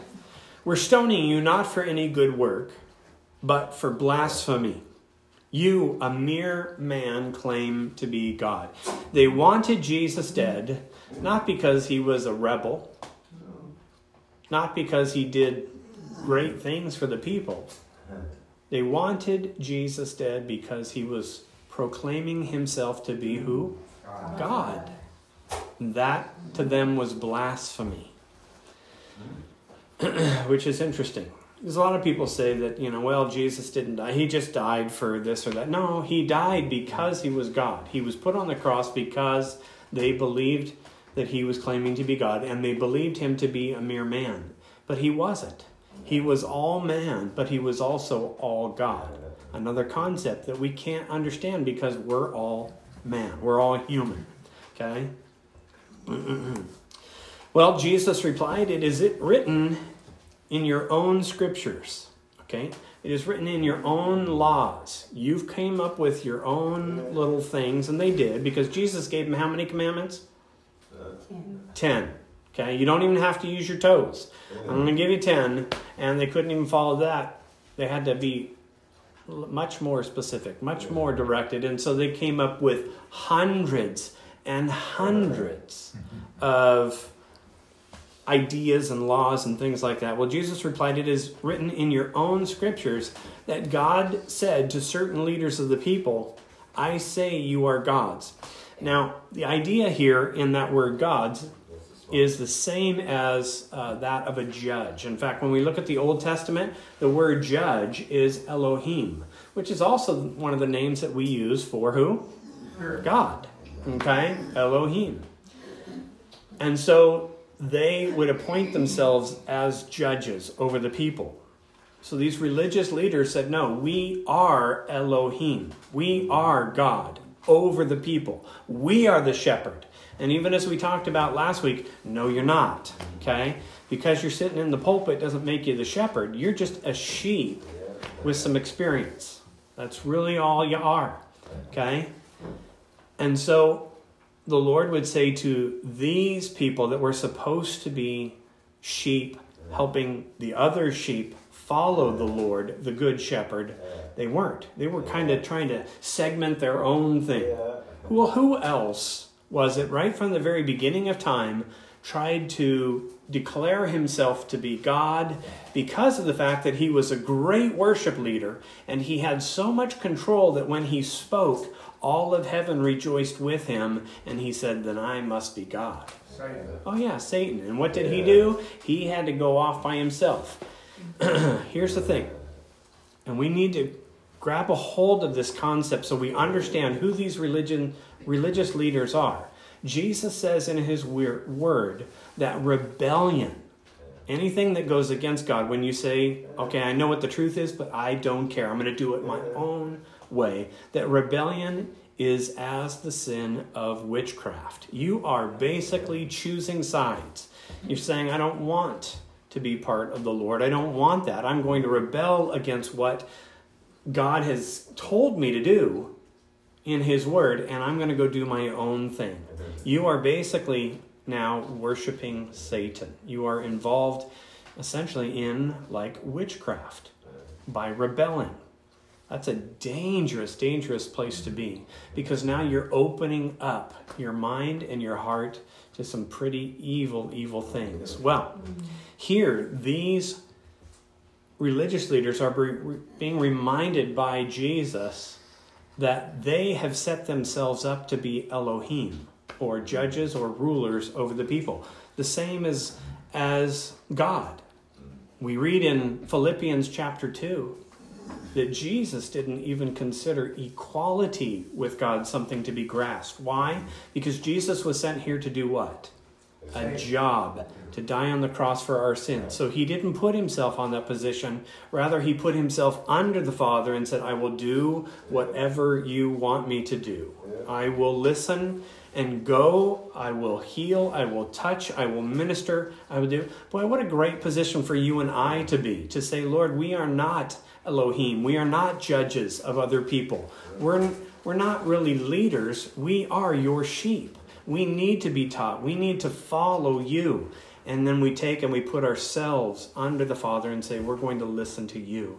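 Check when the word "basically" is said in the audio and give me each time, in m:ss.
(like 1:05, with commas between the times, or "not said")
3:25, 3:40.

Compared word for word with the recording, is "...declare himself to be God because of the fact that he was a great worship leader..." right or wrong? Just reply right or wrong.
right.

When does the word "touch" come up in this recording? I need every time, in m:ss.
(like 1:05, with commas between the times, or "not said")
4:41.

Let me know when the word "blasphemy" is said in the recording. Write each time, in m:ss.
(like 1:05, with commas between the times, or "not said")
0:03, 0:27.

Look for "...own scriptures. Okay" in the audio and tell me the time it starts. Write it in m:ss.
1:00.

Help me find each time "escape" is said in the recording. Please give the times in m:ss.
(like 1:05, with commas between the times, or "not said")
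not said.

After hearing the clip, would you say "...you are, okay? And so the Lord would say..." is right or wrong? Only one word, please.
right.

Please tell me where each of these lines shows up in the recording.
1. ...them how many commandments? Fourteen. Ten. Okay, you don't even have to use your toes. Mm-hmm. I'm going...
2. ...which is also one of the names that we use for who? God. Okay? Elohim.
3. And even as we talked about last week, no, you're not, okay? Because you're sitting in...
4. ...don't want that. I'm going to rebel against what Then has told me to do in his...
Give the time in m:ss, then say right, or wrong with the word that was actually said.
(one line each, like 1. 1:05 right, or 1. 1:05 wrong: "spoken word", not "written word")
1. 1:09 wrong: "Ten", not "Fourteen"
2. 1:49 right
3. 2:10 right
4. 3:30 wrong: "God", not "Then".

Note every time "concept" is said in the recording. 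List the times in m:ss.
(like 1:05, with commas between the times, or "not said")
0:49, 3:05.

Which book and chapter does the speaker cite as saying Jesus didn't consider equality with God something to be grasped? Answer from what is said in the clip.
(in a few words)
Philippians chapter 2.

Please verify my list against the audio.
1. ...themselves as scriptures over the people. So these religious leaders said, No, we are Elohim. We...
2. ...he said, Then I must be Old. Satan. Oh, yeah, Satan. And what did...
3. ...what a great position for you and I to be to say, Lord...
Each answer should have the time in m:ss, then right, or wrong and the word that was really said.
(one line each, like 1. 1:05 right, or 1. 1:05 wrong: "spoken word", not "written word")
1. 1:58 wrong: "judges", not "scriptures"
2. 2:54 wrong: "God", not "Old"
3. 4:43 right.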